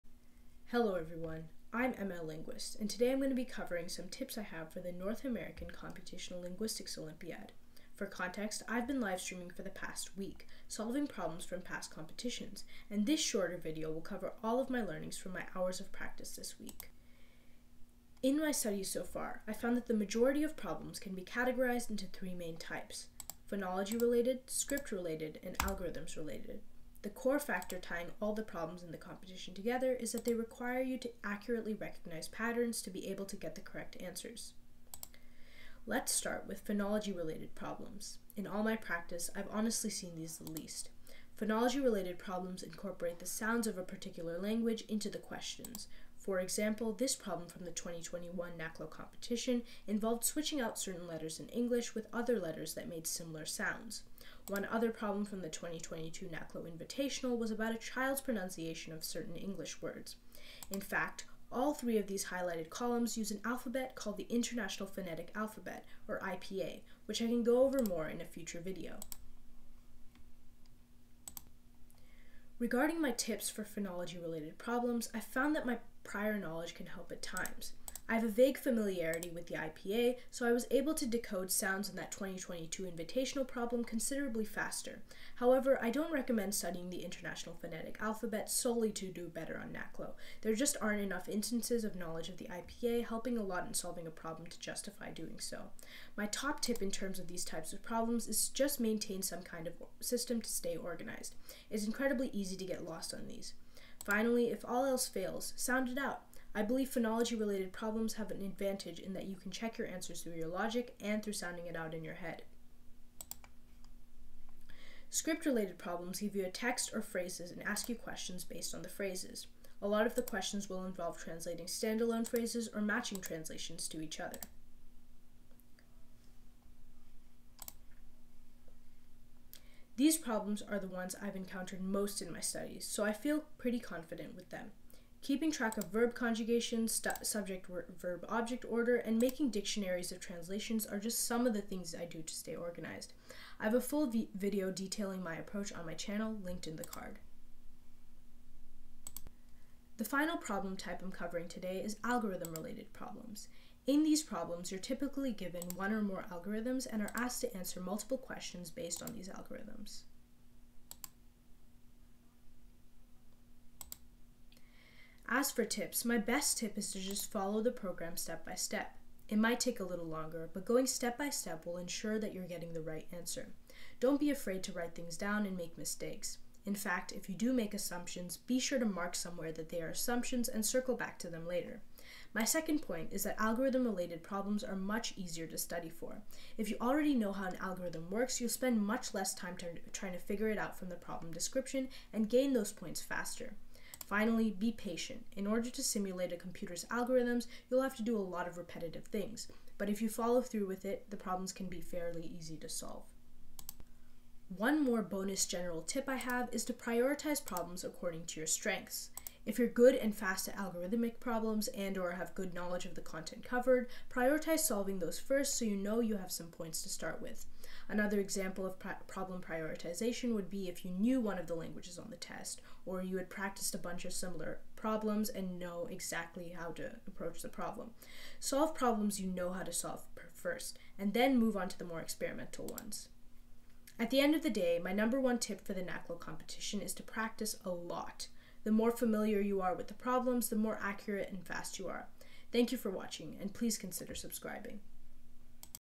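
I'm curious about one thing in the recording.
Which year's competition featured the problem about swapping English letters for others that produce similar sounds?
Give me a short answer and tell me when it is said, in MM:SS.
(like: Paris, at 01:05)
2021, at 00:47.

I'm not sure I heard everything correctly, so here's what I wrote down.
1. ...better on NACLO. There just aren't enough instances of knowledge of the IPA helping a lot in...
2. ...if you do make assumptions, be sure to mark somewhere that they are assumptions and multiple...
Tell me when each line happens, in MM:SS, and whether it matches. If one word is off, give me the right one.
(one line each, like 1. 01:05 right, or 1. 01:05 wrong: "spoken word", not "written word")
1. 01:29 right
2. 02:57 wrong: "circle", not "multiple".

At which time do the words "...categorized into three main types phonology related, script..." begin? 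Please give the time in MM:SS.
00:21.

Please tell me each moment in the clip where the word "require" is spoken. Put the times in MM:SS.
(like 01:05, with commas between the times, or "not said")
00:30.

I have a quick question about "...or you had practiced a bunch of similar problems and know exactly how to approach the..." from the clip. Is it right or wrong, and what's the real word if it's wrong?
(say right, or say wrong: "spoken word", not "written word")
right.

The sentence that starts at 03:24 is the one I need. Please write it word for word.
One more bonus general tip I have is to prioritize problems according to your strengths.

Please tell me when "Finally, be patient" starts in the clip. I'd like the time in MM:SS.
03:14.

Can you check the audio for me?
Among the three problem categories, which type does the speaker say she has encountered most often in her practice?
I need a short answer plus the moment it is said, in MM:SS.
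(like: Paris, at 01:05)
Script related problems, at 01:55.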